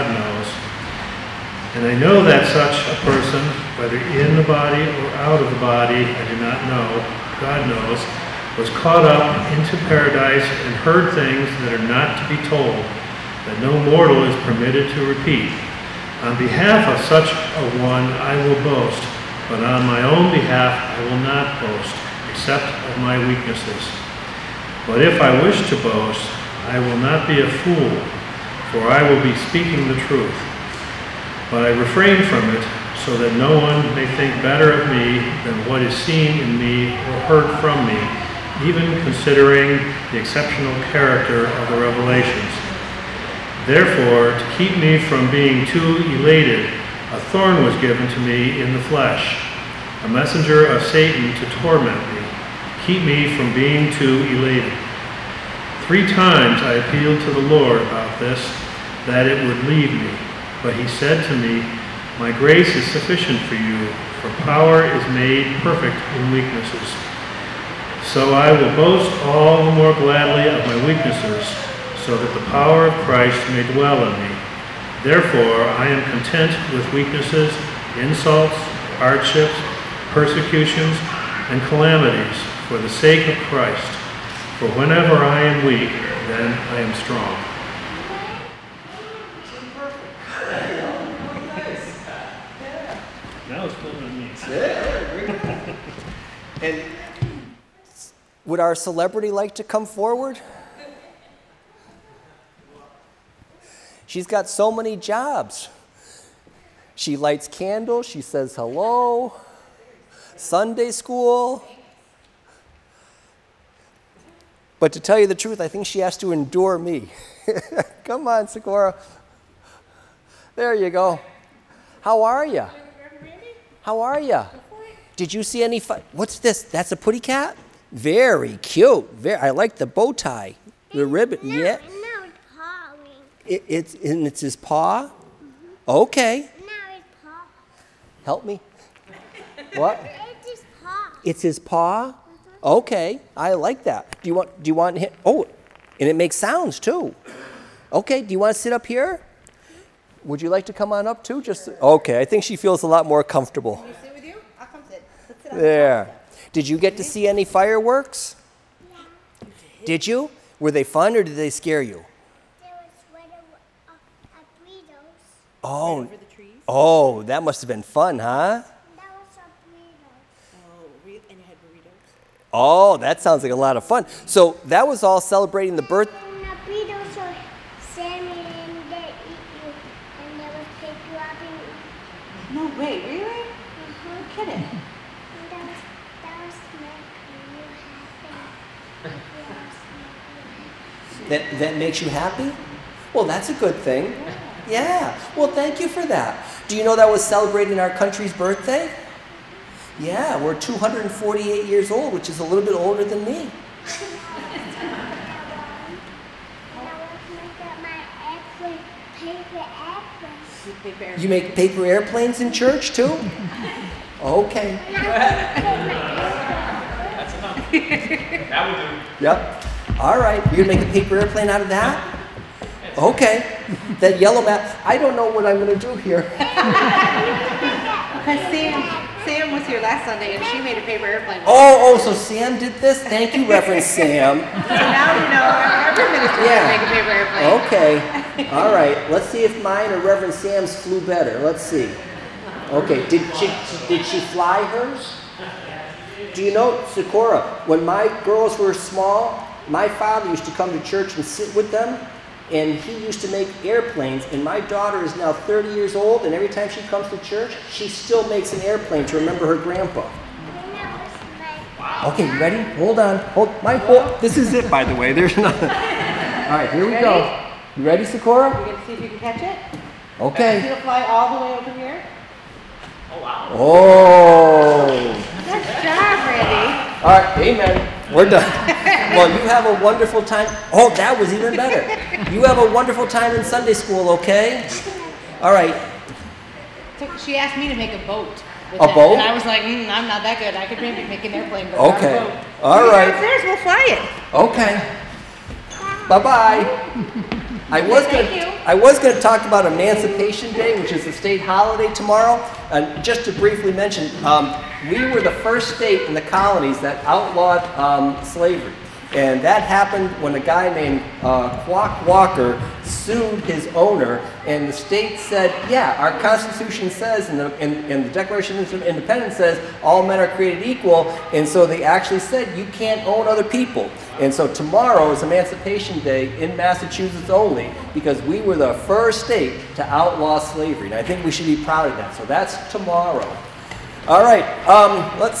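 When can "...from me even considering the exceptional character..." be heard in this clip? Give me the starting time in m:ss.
0:37.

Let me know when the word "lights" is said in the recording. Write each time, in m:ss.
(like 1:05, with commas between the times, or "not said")
1:47.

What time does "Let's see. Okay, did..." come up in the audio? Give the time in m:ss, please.
4:01.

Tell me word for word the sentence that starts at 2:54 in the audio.
So that was all celebrating the birth.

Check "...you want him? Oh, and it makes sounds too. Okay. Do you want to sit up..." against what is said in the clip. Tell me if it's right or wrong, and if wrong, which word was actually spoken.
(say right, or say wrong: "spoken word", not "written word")
right.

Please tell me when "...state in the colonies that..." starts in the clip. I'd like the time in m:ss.
5:05.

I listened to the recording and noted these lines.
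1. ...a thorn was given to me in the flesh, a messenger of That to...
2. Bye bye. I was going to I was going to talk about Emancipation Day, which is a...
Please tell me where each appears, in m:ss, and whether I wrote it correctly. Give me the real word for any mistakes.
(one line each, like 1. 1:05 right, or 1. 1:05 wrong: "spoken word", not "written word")
1. 0:47 wrong: "Satan", not "That"
2. 4:56 right.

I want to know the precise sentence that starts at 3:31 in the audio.
You make paper airplanes in church too?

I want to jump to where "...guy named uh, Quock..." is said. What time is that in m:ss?
5:10.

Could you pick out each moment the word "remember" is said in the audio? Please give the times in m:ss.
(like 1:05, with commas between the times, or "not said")
4:19.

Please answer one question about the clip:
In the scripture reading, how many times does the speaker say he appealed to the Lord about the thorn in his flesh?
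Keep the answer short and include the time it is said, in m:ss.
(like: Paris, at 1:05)
3, at 0:55.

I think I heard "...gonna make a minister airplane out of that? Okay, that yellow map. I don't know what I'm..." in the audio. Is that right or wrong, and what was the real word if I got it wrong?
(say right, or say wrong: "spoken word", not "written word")
wrong: "paper", not "minister".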